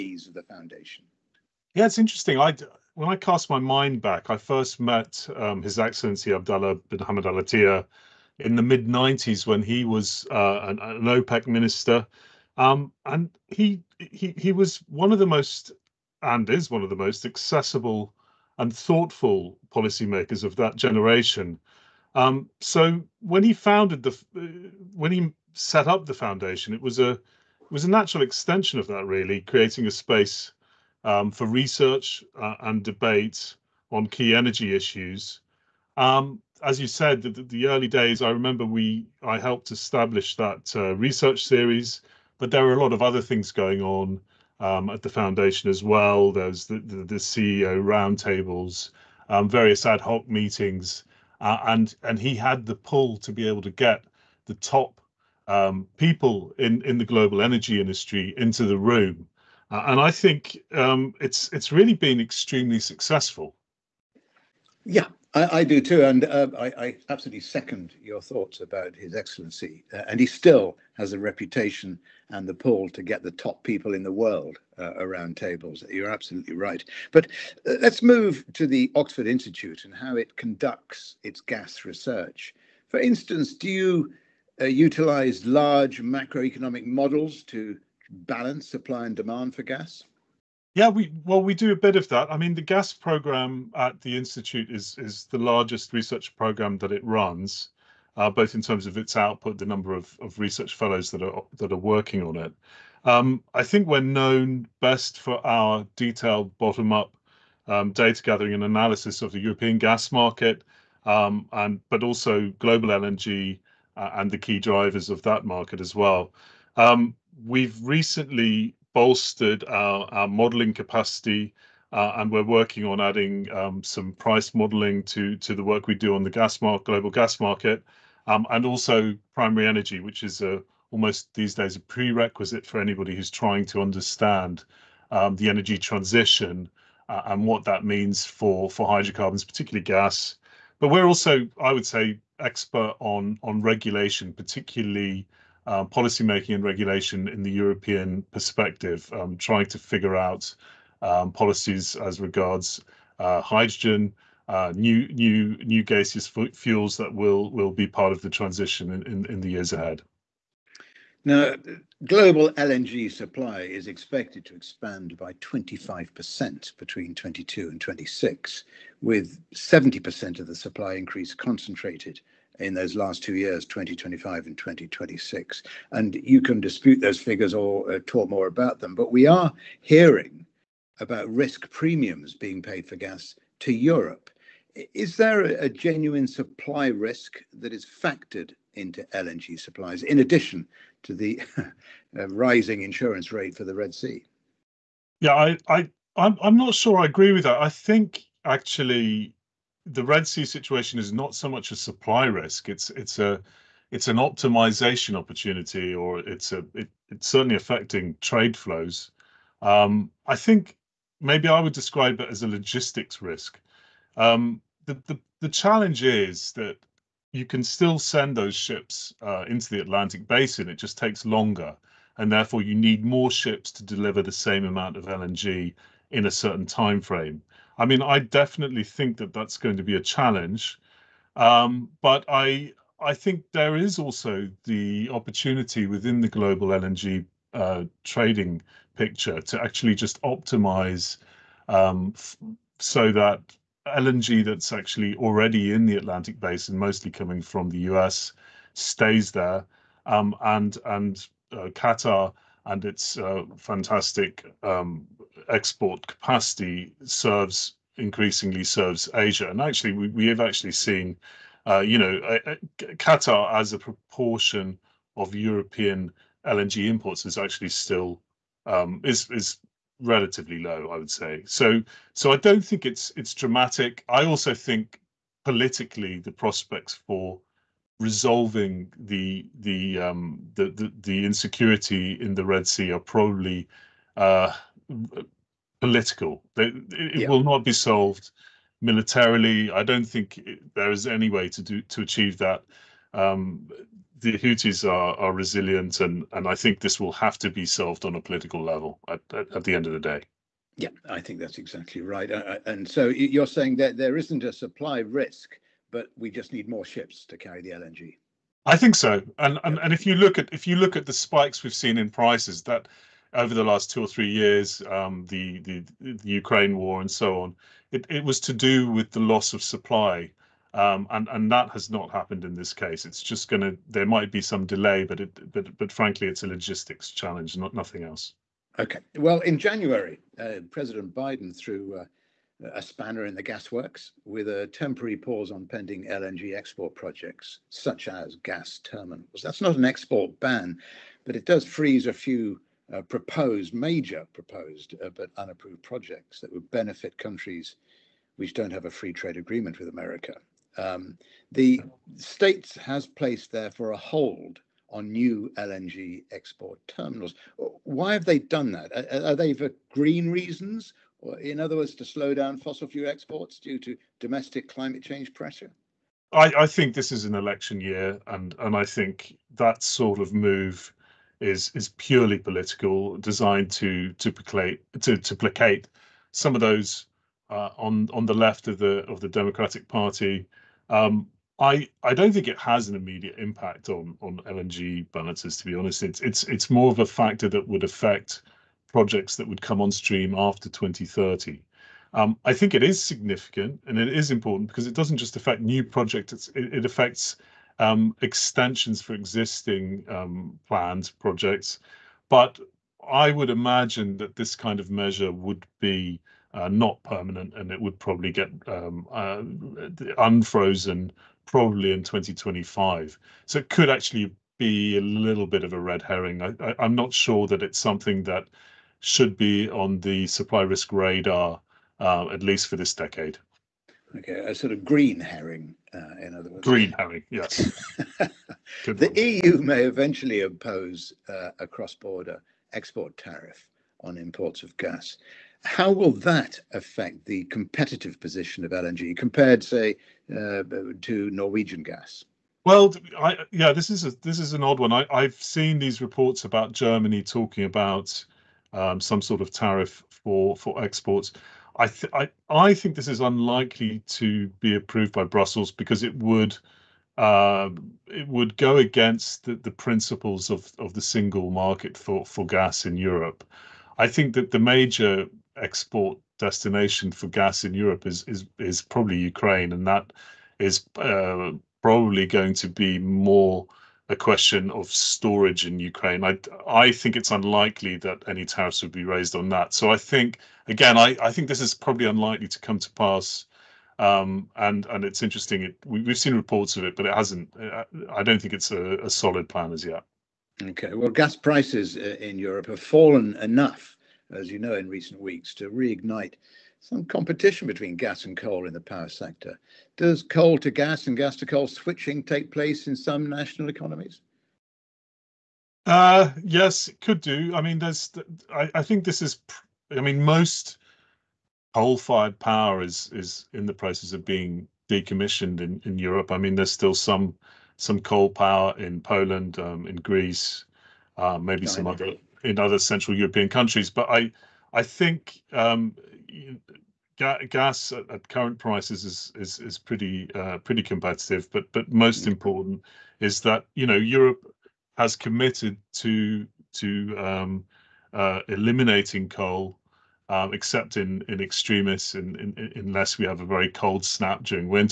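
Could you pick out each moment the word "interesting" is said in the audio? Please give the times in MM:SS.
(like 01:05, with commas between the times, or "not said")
00:01, 08:05.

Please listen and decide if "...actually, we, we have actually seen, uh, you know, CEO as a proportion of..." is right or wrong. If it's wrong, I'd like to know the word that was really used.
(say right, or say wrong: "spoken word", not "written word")
wrong: "Qatar", not "CEO".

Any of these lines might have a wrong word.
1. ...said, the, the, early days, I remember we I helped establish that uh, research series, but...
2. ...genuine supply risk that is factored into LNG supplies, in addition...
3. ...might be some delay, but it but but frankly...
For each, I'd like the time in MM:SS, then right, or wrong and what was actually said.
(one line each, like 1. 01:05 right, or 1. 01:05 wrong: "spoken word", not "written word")
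1. 00:36 right
2. 03:05 right
3. 05:24 right.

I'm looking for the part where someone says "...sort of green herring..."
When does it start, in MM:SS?
07:04.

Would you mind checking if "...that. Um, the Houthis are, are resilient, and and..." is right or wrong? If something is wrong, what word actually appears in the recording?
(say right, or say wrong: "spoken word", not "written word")
right.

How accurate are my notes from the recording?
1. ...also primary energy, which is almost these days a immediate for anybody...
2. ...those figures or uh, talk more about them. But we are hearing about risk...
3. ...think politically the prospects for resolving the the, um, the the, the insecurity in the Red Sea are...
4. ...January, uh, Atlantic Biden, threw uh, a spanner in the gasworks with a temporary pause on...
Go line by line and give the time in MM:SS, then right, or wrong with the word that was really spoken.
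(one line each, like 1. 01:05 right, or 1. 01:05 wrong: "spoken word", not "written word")
1. 02:08 wrong: "prerequisite", not "immediate"
2. 02:56 right
3. 04:34 right
4. 05:29 wrong: "President", not "Atlantic".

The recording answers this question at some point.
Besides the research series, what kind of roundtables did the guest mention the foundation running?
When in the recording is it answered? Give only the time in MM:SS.
00:47.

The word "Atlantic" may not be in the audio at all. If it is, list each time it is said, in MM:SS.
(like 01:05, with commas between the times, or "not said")
03:39, 04:05.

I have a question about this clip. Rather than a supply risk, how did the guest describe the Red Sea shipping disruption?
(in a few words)
a logistics risk.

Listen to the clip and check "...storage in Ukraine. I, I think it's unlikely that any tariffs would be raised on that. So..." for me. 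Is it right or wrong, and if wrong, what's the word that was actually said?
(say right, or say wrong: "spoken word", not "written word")
right.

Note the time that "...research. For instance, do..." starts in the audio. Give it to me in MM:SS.
01:21.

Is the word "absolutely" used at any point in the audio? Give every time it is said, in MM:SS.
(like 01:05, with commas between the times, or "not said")
01:07, 01:16.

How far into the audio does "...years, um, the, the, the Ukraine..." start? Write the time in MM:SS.
05:14.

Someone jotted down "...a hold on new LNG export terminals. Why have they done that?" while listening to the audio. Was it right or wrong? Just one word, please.
right.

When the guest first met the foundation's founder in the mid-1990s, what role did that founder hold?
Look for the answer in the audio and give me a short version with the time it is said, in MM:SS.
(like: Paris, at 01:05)
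OPEC minister, at 00:11.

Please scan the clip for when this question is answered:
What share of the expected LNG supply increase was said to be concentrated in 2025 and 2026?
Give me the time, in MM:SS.
02:49.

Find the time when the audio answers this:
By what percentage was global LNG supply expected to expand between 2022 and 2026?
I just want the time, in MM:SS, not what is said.
02:45.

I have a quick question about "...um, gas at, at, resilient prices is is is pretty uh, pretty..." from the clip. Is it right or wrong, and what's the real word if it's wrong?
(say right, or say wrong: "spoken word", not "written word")
wrong: "current", not "resilient".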